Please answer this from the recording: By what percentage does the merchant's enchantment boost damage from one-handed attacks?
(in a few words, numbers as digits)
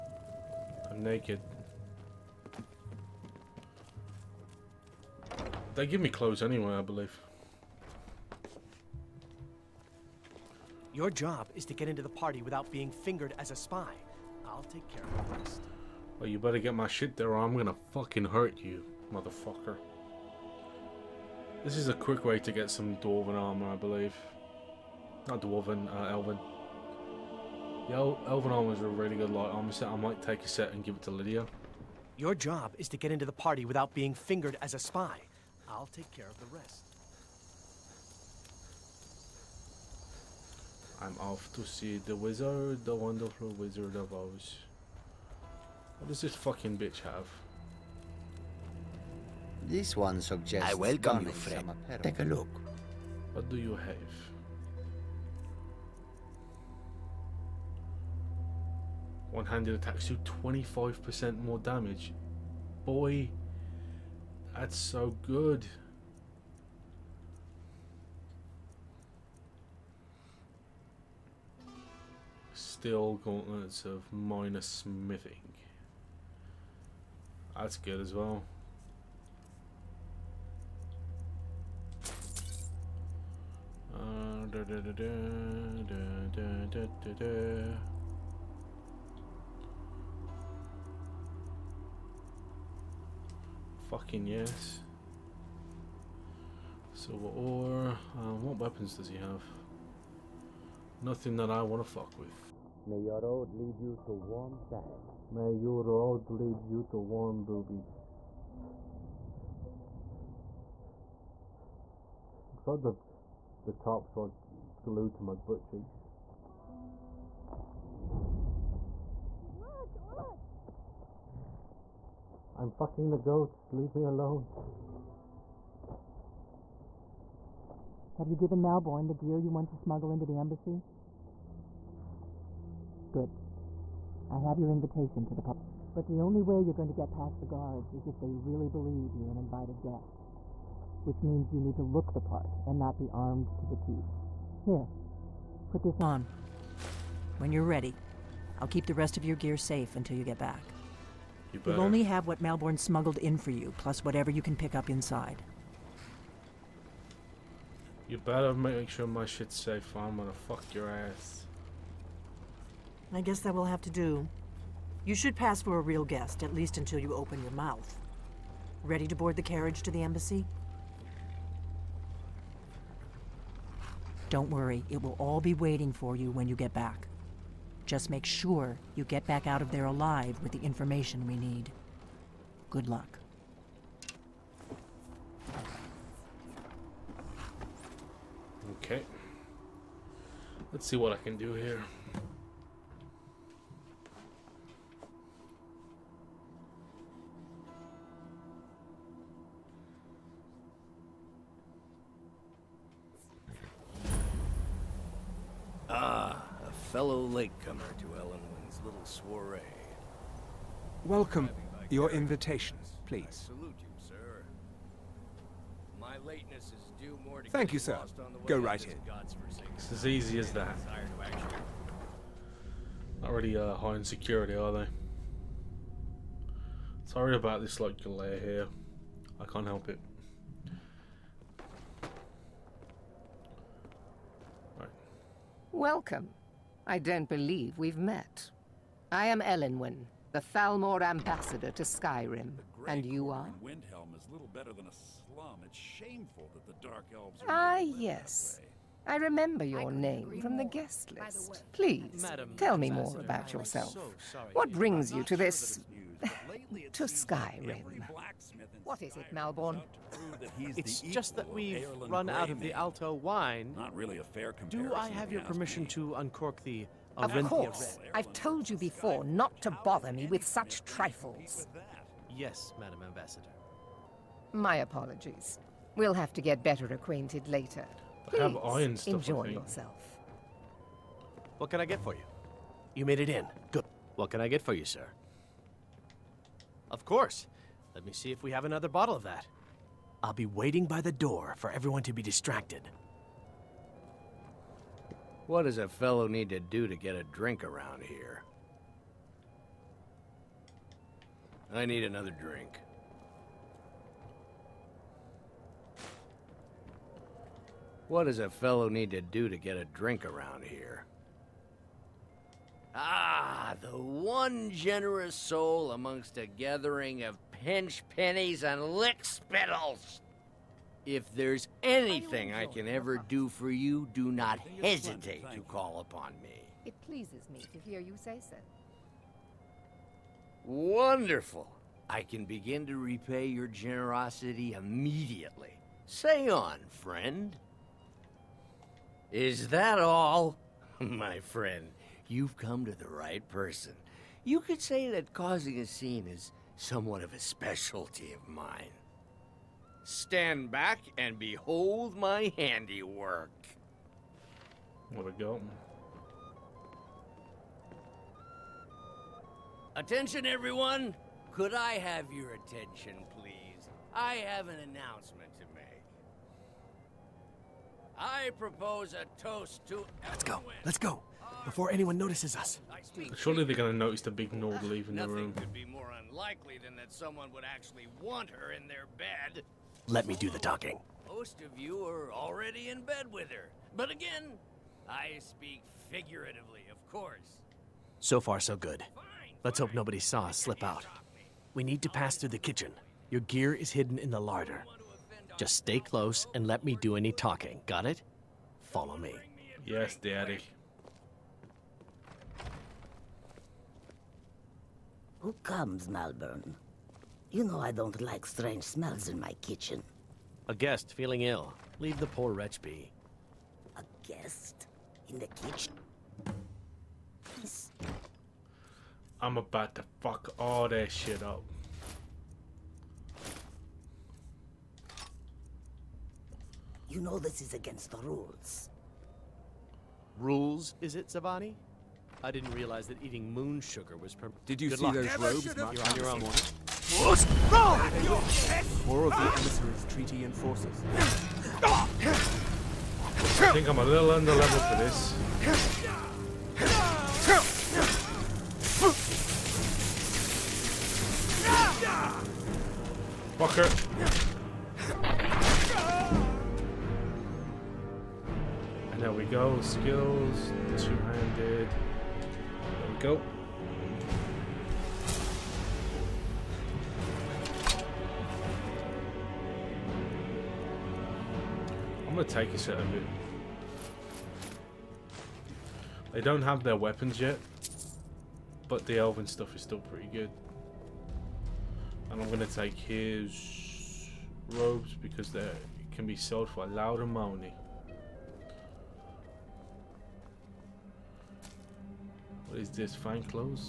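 25%.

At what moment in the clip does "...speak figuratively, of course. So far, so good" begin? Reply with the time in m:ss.
6:25.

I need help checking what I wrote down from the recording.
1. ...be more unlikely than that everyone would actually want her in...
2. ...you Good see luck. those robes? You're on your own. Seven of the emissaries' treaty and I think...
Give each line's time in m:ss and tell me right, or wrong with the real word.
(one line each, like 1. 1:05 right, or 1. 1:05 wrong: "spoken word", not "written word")
1. 6:15 wrong: "someone", not "everyone"
2. 7:14 wrong: "Four", not "Seven".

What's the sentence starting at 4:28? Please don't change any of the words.
I've told you before not to bother me with such trifles.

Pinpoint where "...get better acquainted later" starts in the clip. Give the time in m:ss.
4:36.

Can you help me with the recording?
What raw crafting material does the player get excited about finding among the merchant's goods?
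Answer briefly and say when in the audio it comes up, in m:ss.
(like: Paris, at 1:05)
Silver ore, at 1:36.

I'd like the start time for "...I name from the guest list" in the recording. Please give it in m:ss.
4:09.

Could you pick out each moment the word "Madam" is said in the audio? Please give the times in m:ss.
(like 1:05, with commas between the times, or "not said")
4:12, 4:32.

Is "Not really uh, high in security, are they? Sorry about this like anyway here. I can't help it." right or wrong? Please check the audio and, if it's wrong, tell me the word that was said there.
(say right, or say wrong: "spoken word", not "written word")
wrong: "delay", not "anyway".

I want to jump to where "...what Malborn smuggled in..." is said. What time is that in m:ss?
2:32.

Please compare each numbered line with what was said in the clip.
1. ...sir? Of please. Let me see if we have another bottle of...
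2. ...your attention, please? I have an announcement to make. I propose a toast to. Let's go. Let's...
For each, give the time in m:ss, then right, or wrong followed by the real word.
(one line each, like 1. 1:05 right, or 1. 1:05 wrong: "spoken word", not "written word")
1. 4:44 wrong: "course", not "please"
2. 6:02 right.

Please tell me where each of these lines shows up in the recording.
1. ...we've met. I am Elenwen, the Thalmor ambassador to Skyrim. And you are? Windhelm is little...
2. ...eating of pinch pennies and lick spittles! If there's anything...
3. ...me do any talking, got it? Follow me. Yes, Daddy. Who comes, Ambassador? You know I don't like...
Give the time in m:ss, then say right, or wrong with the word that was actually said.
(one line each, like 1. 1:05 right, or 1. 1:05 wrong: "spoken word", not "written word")
1. 3:57 right
2. 5:16 wrong: "gathering", not "eating"
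3. 6:36 wrong: "Malborn", not "Ambassador".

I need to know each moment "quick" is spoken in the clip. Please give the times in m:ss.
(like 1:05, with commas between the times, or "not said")
0:21.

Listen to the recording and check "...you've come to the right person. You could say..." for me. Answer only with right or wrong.
right.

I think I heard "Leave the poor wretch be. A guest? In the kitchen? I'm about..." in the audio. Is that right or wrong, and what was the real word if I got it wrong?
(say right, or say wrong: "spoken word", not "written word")
right.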